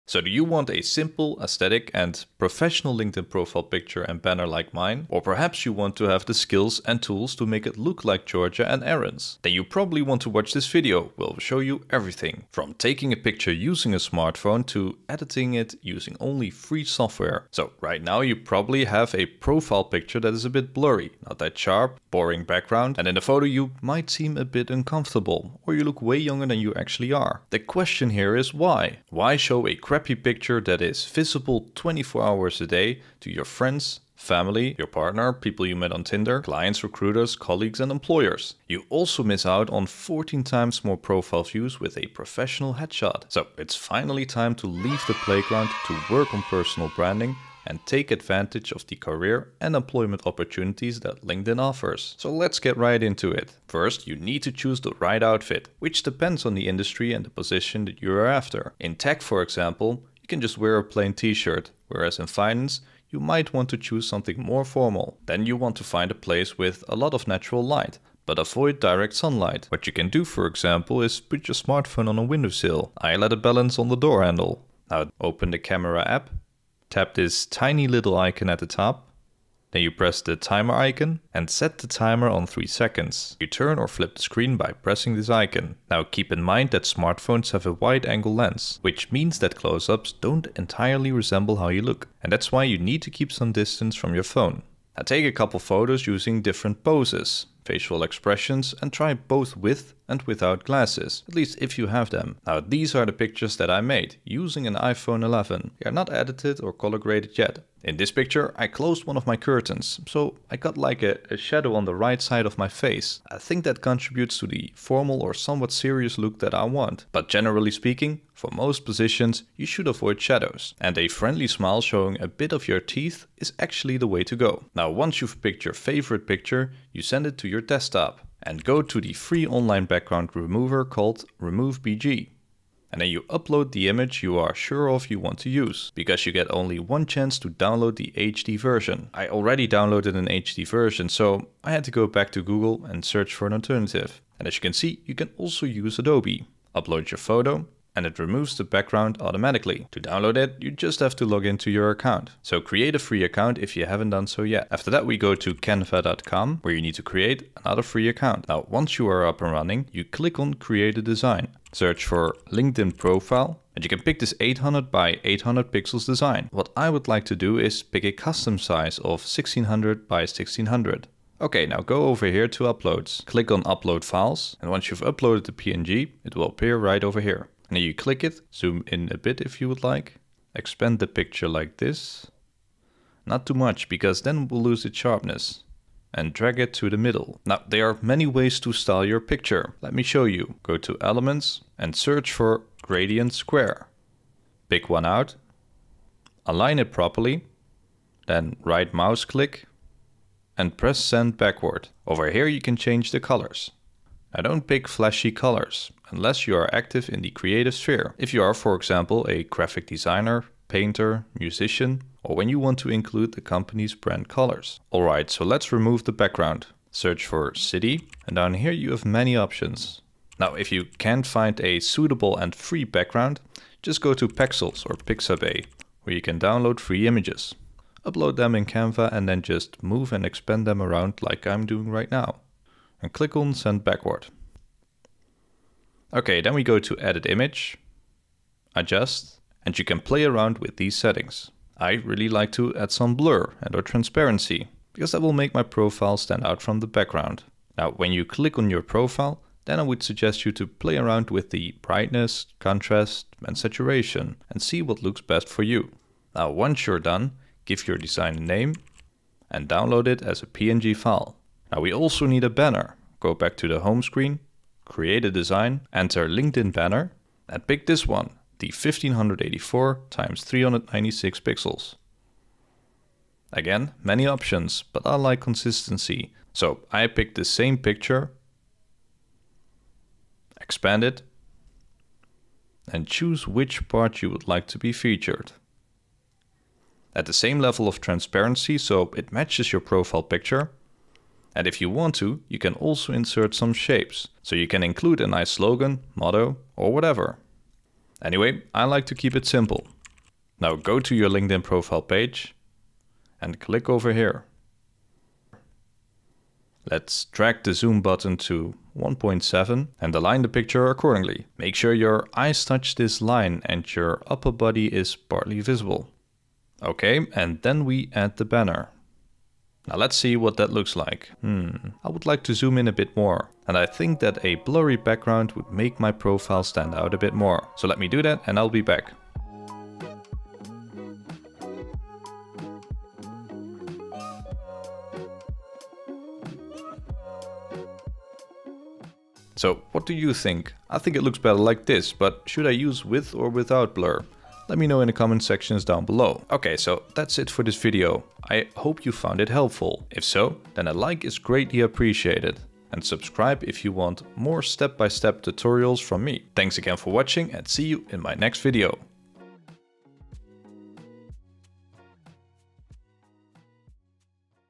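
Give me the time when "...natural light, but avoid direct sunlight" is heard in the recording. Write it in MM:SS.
01:07.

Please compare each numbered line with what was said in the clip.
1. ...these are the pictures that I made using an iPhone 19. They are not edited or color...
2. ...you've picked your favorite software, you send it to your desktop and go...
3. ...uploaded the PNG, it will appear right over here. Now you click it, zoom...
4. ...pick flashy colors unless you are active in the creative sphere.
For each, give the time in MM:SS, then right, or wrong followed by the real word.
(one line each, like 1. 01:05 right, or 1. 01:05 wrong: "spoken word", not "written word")
1. 01:42 wrong: "11", not "19"
2. 02:05 wrong: "picture", not "software"
3. 02:55 right
4. 03:24 right.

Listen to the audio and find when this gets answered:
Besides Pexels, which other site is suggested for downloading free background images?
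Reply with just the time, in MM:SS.
03:44.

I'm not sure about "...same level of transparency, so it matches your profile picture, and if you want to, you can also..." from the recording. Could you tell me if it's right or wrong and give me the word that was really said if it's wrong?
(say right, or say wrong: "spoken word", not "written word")
right.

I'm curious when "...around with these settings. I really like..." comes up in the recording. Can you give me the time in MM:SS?
04:00.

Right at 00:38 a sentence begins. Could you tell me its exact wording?
You also miss out on 14 times more profile views with a professional headshot.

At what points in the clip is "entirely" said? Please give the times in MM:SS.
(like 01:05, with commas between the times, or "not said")
01:30.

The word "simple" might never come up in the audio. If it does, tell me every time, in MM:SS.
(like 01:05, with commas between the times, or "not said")
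00:00, 04:59.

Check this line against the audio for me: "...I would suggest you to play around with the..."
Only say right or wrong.
right.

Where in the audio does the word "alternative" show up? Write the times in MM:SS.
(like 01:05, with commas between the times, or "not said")
02:23.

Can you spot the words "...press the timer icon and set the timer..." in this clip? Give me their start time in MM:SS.
01:19.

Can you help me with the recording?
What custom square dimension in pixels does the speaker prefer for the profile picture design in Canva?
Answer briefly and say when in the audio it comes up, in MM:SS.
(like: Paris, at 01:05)
1600 by 1600, at 02:49.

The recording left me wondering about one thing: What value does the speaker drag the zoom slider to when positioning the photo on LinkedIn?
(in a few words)
1.7.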